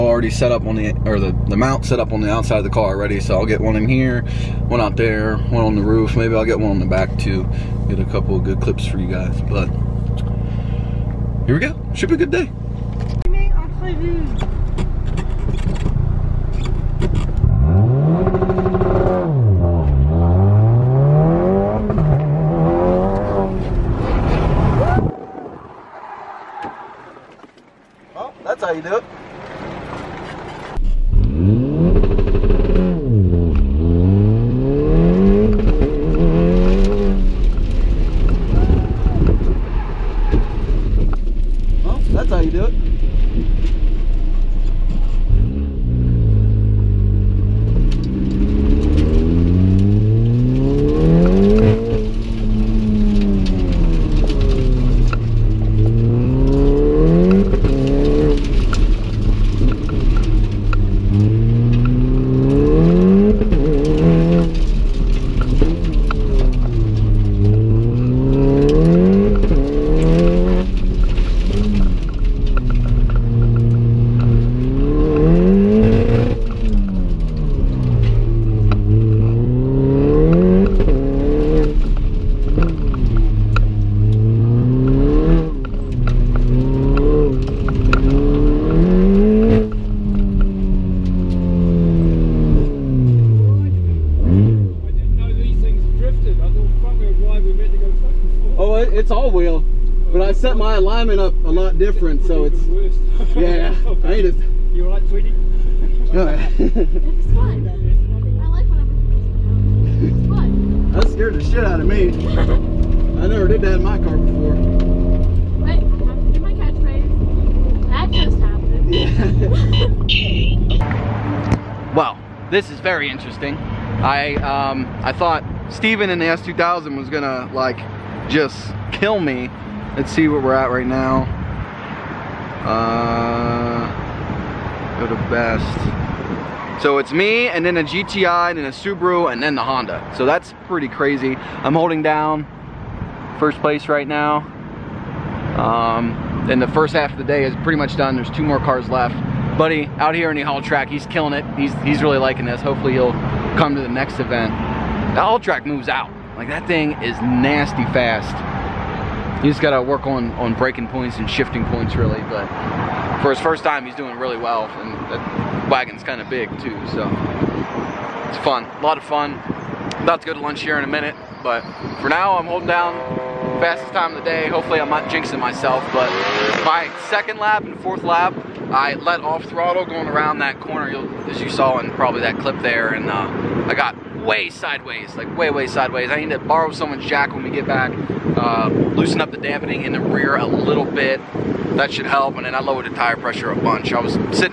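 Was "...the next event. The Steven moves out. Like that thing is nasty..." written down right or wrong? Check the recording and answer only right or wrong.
wrong.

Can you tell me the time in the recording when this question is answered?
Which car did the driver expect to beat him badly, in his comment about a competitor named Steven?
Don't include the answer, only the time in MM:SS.
02:06.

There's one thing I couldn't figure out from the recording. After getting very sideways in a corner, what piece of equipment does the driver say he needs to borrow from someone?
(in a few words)
Jack.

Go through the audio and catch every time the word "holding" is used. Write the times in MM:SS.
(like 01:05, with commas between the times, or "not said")
02:21, 02:52.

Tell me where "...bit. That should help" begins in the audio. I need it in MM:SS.
03:10.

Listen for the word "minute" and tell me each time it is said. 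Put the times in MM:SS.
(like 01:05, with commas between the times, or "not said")
02:50.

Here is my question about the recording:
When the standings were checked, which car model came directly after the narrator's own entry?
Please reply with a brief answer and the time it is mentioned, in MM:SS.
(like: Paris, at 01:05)
GTI, at 02:17.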